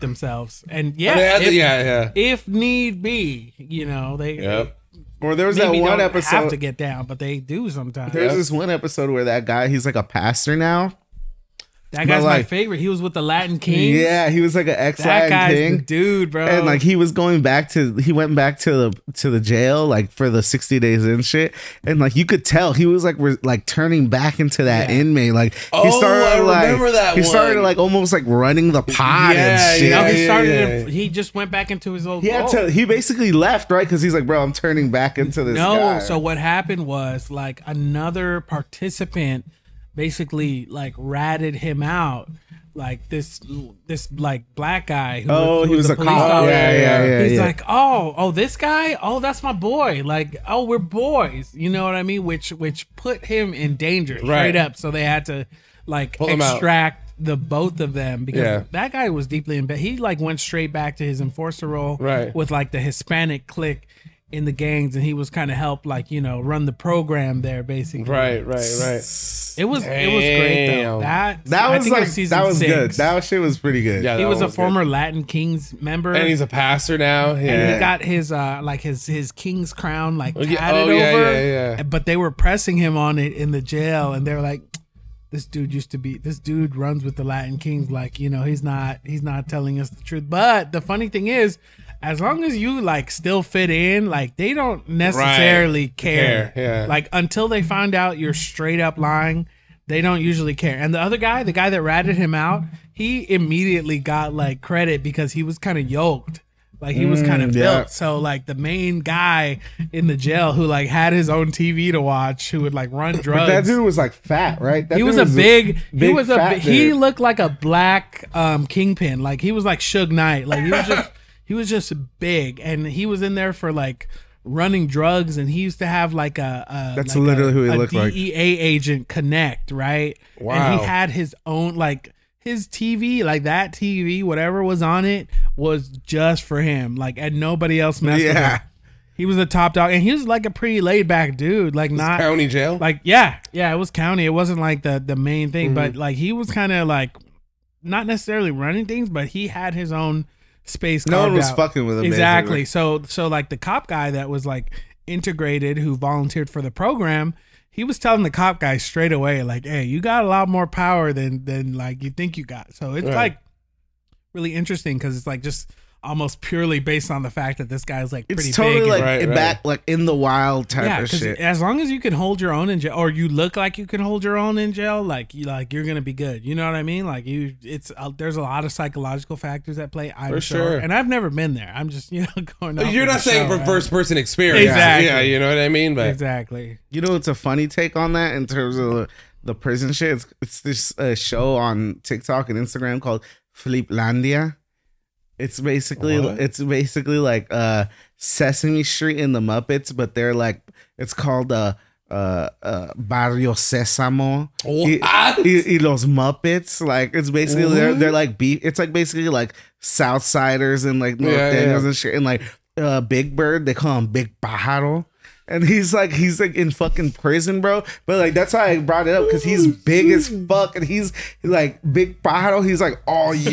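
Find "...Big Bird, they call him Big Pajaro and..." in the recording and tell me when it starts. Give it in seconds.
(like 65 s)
212 s.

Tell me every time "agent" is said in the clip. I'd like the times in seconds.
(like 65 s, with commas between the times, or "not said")
128 s.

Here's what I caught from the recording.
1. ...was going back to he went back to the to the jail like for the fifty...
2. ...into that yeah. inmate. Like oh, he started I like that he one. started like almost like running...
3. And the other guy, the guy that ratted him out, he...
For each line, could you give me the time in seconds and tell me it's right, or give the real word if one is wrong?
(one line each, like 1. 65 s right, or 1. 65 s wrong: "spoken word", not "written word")
1. 16 s wrong: "sixty", not "fifty"
2. 24 s right
3. 100 s right.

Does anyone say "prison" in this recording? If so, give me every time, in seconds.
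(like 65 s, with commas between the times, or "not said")
189 s, 217 s.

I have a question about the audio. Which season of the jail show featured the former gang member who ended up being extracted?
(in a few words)
Season 6.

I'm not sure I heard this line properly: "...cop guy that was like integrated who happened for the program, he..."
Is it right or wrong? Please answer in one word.
wrong.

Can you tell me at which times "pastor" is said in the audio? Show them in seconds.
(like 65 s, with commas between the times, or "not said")
10 s, 76 s.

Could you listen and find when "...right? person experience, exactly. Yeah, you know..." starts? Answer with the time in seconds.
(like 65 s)
183 s.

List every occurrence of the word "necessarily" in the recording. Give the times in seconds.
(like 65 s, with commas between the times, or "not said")
94 s, 148 s.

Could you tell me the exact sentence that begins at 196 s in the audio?
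it's basically like uh Sesame Street in the Muppets, but they're like it's called uh uh, uh Barrio Sesamo oh, y, ah.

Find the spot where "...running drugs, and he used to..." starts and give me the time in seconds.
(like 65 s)
124 s.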